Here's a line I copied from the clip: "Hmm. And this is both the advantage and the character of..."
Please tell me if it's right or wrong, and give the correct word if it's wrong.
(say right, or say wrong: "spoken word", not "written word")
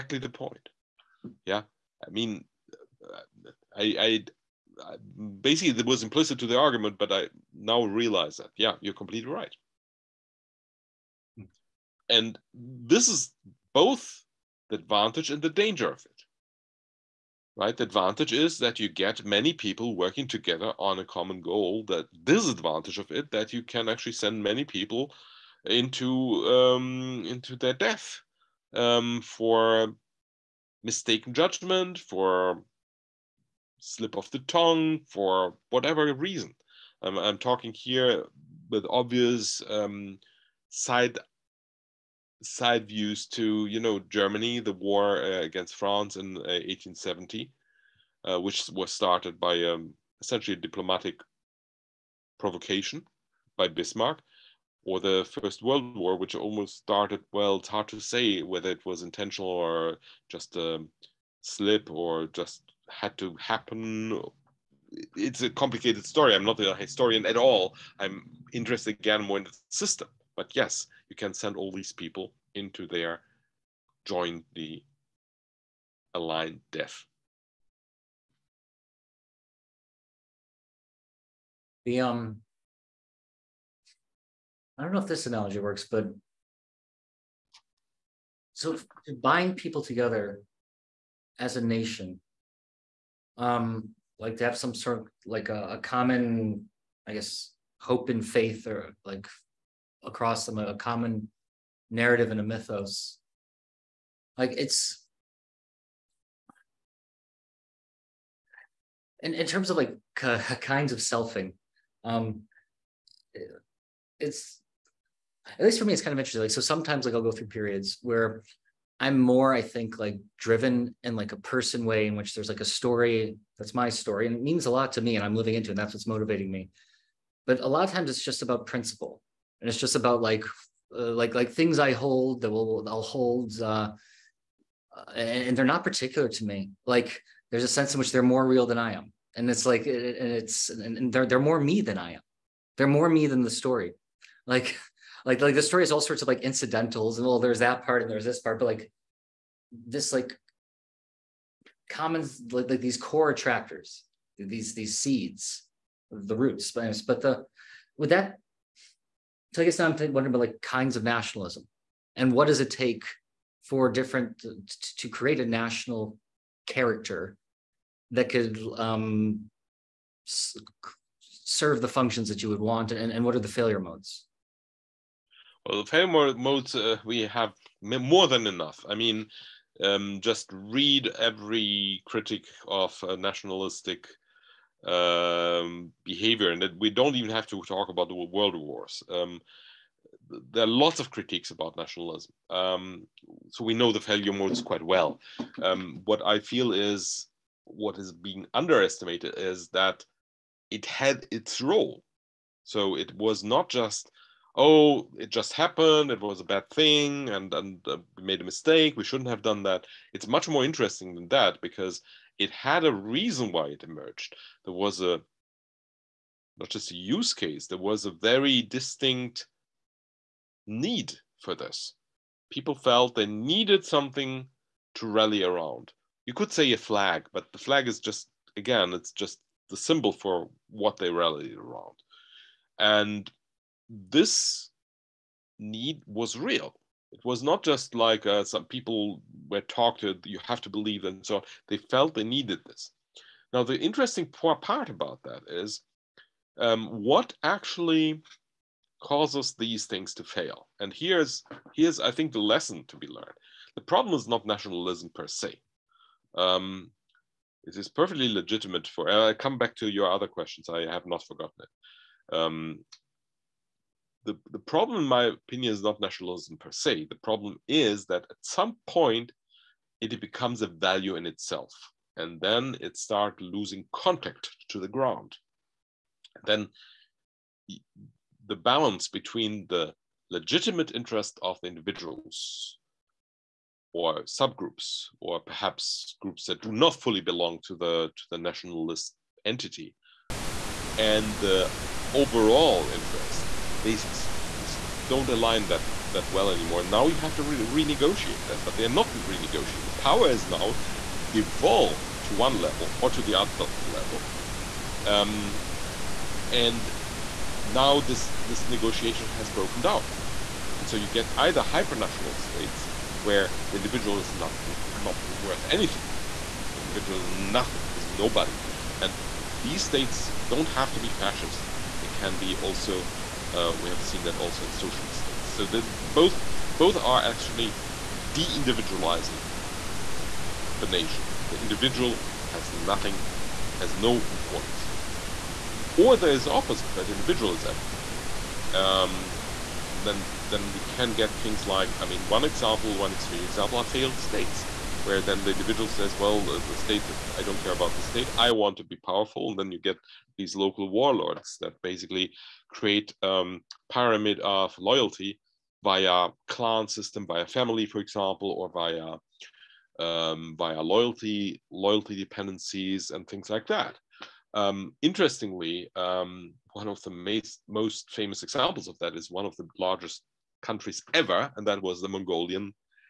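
wrong: "danger", not "character".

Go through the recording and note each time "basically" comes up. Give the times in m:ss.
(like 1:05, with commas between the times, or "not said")
0:05, 5:51.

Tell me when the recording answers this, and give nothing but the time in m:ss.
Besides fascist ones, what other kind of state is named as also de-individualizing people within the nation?
5:24.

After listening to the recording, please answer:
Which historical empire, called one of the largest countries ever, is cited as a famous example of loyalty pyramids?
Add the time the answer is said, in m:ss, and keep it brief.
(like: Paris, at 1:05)
Mongolian, at 6:12.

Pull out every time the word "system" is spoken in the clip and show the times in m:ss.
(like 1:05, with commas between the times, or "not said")
1:09, 5:56.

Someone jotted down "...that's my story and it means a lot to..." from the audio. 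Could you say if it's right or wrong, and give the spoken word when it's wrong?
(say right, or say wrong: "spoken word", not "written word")
right.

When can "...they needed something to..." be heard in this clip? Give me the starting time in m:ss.
3:43.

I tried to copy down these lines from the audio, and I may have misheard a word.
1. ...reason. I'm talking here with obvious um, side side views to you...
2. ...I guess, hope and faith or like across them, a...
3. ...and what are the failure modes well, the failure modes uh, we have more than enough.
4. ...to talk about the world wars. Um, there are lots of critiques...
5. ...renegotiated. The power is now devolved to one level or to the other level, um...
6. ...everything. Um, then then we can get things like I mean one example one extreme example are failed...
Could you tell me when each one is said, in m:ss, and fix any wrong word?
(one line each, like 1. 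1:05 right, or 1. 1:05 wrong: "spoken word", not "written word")
1. 0:36 right
2. 1:37 right
3. 2:53 right
4. 3:07 right
5. 4:59 right
6. 5:37 right.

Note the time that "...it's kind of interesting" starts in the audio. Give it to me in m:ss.
1:55.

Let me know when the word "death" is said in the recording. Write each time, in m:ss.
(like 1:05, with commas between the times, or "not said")
0:27, 1:16.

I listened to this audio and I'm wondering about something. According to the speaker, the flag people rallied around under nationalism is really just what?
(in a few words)
the symbol.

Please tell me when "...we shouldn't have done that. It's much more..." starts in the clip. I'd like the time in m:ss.
3:28.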